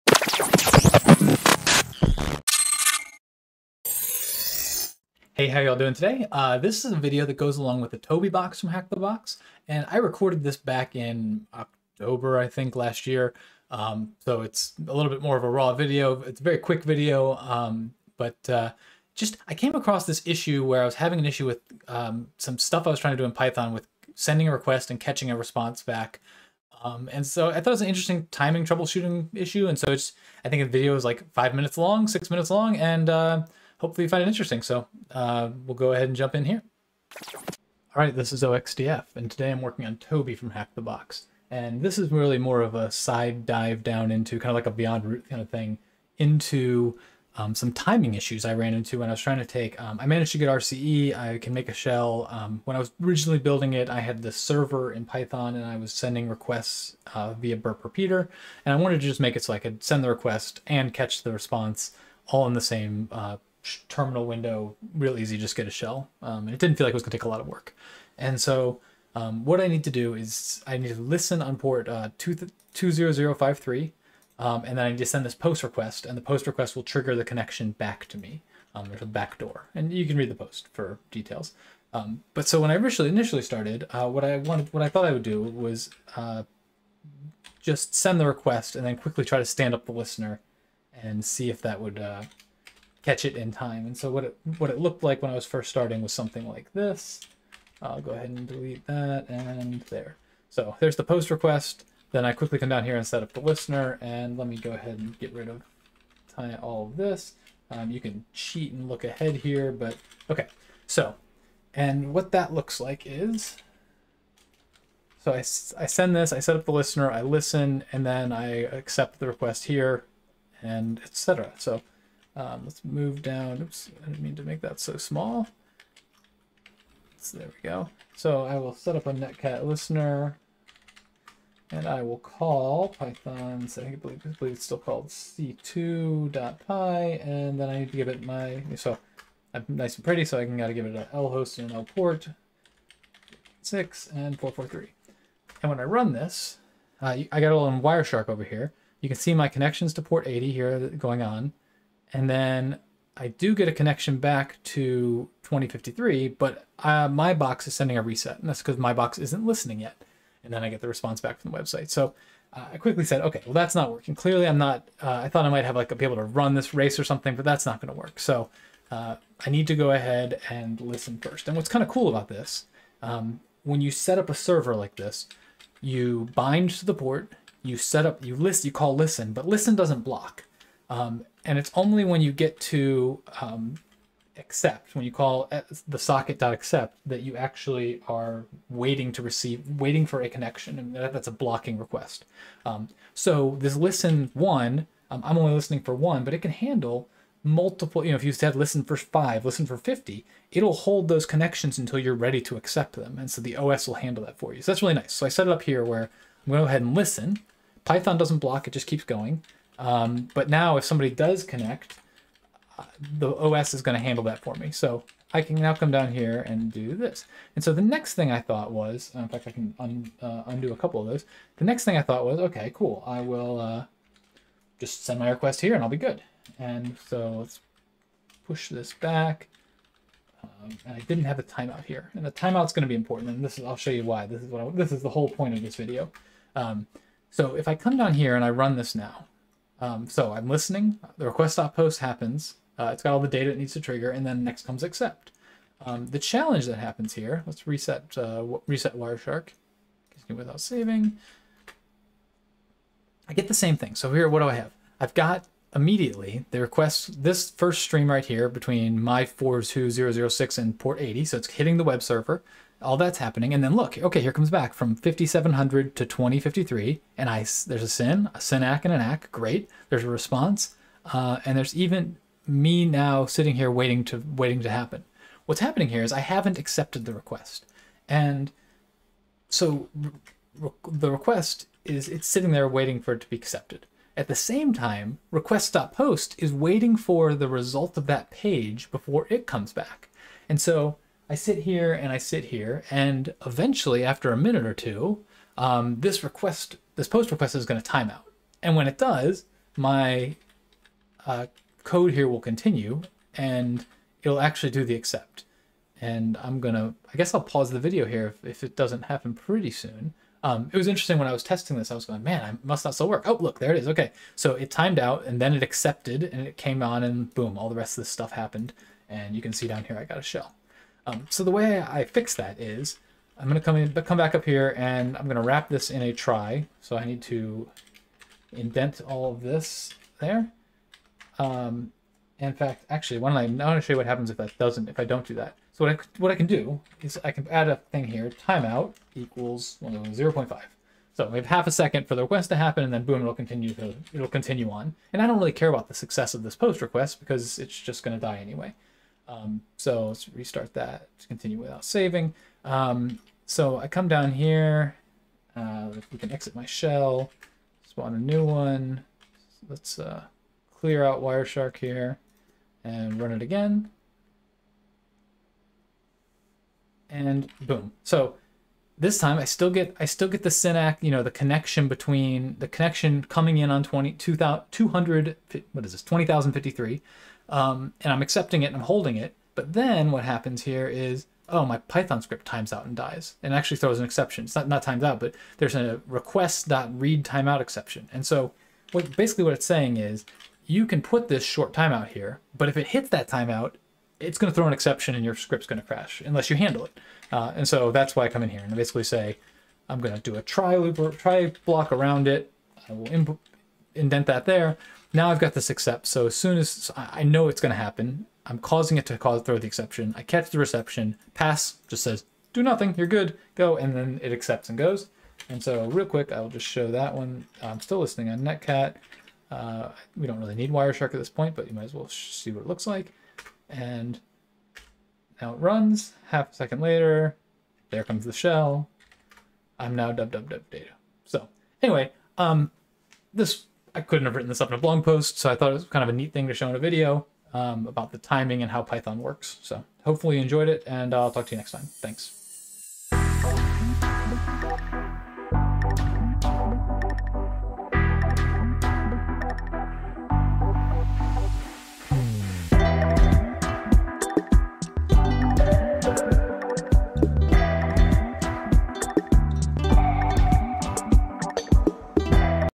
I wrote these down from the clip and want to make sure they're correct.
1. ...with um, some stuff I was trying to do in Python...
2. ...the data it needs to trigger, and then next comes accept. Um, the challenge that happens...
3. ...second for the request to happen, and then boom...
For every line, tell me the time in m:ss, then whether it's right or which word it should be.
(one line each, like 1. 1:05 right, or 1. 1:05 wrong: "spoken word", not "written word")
1. 0:21 right
2. 4:03 right
3. 5:41 right.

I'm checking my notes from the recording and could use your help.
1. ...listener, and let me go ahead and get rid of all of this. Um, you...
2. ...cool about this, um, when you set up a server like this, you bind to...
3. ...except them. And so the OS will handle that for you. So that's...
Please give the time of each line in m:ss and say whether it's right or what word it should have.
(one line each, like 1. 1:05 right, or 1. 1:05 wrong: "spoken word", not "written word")
1. 1:43 right
2. 2:51 right
3. 3:22 wrong: "accept", not "except".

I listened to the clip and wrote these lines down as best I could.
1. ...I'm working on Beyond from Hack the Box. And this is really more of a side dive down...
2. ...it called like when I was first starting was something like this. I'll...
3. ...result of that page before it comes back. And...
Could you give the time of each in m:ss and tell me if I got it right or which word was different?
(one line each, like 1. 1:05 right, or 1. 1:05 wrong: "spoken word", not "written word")
1. 0:39 wrong: "Toby", not "Beyond"
2. 1:34 wrong: "looked", not "called"
3. 4:47 right.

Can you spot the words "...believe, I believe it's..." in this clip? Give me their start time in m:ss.
2:13.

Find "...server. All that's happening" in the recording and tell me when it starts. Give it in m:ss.
4:22.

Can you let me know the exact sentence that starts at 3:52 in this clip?
And the timeout's going to be important.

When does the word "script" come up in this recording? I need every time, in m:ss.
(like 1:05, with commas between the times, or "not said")
6:22, 6:35.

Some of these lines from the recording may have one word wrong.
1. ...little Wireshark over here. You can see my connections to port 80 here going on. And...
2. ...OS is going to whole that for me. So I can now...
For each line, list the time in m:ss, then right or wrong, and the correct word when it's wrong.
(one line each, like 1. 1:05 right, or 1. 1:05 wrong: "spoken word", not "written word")
1. 2:27 right
2. 3:33 wrong: "handle", not "whole".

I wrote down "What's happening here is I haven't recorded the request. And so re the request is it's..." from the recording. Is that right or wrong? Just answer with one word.
wrong.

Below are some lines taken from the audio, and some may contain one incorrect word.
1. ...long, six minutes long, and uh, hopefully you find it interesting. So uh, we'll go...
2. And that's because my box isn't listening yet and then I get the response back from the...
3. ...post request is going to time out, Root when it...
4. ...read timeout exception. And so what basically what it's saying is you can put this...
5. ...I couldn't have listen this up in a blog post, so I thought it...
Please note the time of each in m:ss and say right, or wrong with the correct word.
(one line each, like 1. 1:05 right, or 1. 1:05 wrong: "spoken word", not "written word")
1. 0:31 right
2. 2:38 right
3. 4:57 wrong: "And", not "Root"
4. 6:26 right
5. 7:13 wrong: "written", not "listen".